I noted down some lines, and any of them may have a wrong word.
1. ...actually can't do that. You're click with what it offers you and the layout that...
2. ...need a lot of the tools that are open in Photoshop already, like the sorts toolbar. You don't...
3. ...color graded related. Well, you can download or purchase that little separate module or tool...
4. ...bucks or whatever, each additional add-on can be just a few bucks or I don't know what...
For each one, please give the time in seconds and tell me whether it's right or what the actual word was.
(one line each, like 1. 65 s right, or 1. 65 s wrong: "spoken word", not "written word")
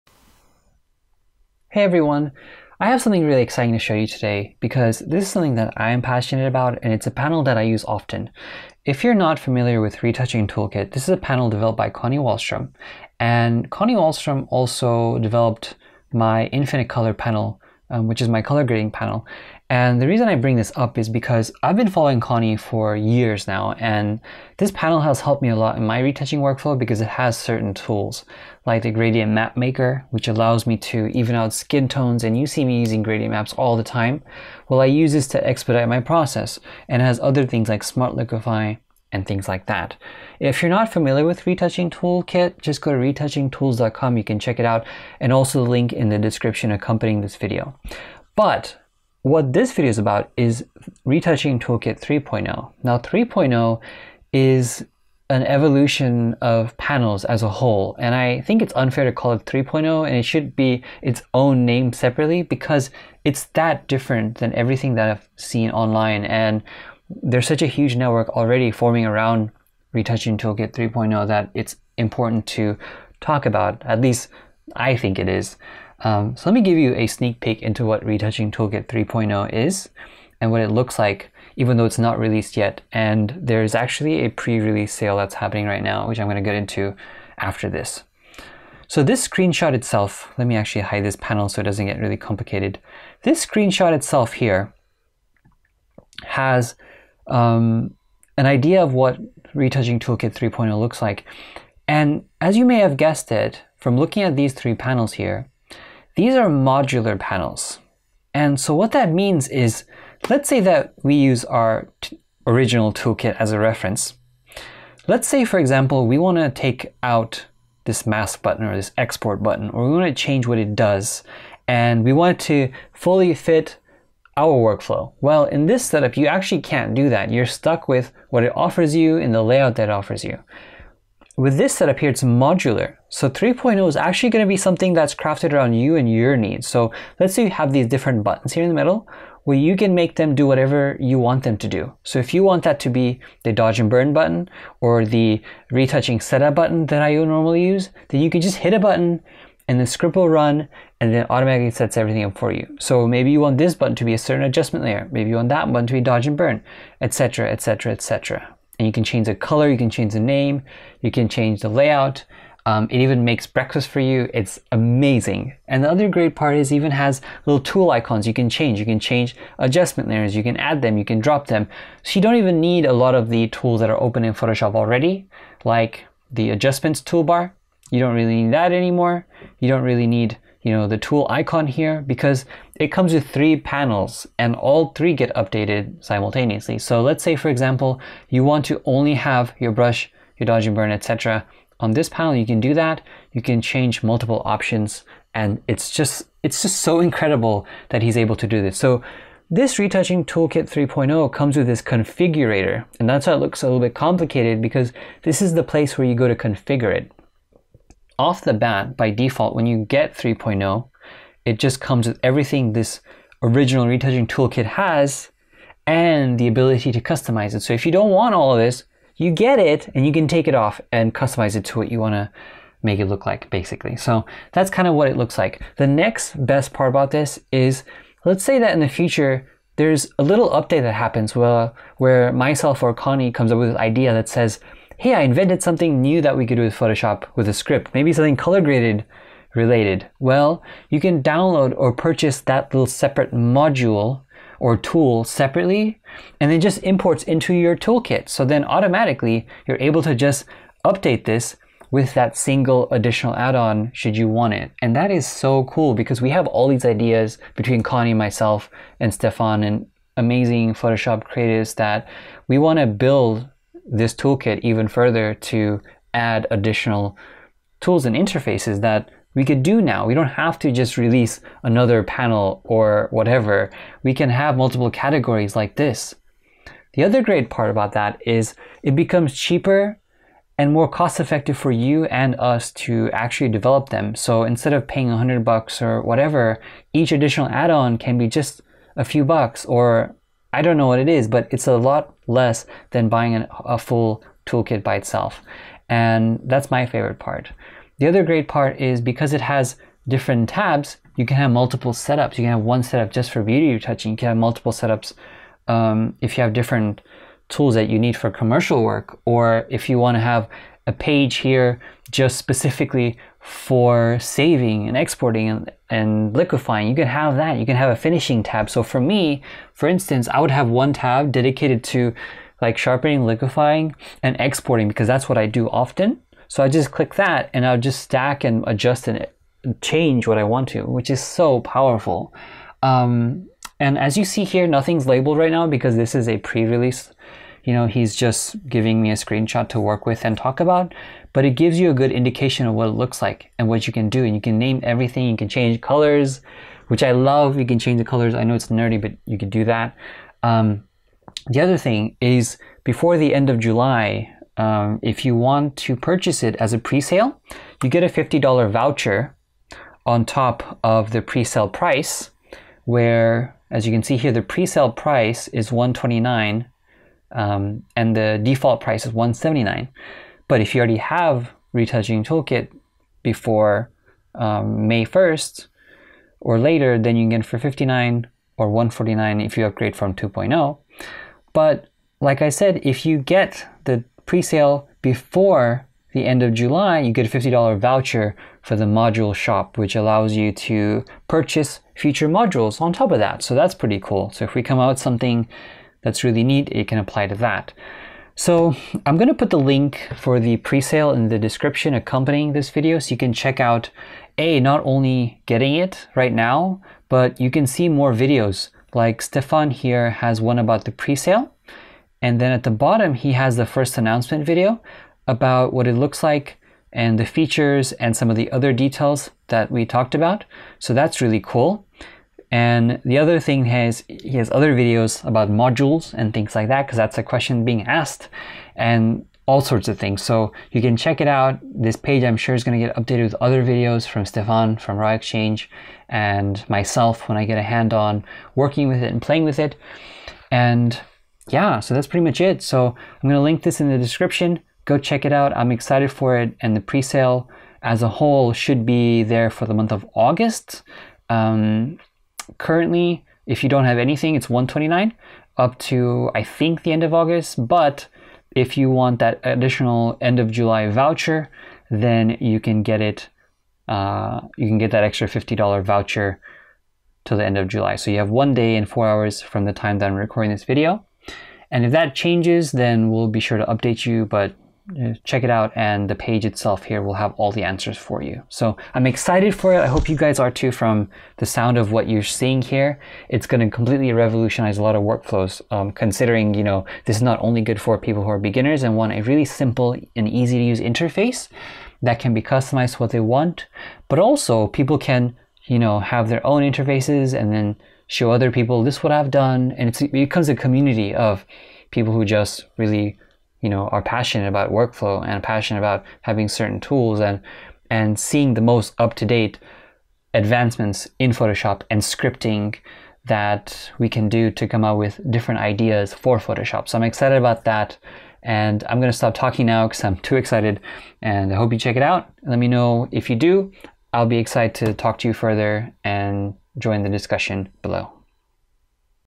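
1. 126 s wrong: "stuck", not "click"
2. 172 s wrong: "adjustments", not "sorts"
3. 238 s right
4. 285 s right.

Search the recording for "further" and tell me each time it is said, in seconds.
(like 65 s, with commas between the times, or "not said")
264 s, 525 s.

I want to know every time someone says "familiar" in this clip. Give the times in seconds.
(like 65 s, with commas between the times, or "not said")
9 s, 40 s.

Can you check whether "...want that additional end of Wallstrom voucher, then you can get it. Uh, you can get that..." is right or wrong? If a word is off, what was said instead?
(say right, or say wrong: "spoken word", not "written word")
wrong: "July", not "Wallstrom".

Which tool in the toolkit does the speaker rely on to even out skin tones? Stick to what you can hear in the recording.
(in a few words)
gradient map maker.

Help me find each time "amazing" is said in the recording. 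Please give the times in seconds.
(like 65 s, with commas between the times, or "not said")
164 s, 260 s.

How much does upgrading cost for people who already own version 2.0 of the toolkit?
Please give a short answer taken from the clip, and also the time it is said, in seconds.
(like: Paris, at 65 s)
149, at 378 s.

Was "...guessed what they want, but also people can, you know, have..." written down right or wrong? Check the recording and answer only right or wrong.
wrong.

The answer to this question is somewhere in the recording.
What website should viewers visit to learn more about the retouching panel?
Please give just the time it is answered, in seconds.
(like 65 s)
42 s.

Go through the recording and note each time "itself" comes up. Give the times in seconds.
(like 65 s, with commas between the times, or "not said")
89 s, 93 s, 294 s, 476 s.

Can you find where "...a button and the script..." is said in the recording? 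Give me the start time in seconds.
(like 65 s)
148 s.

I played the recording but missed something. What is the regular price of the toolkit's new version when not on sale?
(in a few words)
179.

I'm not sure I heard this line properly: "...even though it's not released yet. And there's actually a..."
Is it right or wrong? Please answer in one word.
right.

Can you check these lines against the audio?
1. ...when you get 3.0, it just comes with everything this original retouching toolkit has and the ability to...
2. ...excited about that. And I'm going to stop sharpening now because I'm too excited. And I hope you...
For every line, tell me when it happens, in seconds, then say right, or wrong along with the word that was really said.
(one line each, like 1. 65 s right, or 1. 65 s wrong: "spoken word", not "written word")
1. 209 s right
2. 517 s wrong: "talking", not "sharpening".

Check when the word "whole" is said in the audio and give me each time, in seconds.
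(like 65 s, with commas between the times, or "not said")
57 s, 448 s.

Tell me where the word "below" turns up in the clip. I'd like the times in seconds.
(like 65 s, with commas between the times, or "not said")
527 s.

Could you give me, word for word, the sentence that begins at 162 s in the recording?
Um, it even makes breakfast for you.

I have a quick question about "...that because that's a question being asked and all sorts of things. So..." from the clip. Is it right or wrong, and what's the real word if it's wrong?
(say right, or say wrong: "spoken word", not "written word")
right.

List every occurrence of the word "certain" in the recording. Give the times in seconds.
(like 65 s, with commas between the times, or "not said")
27 s, 154 s, 506 s.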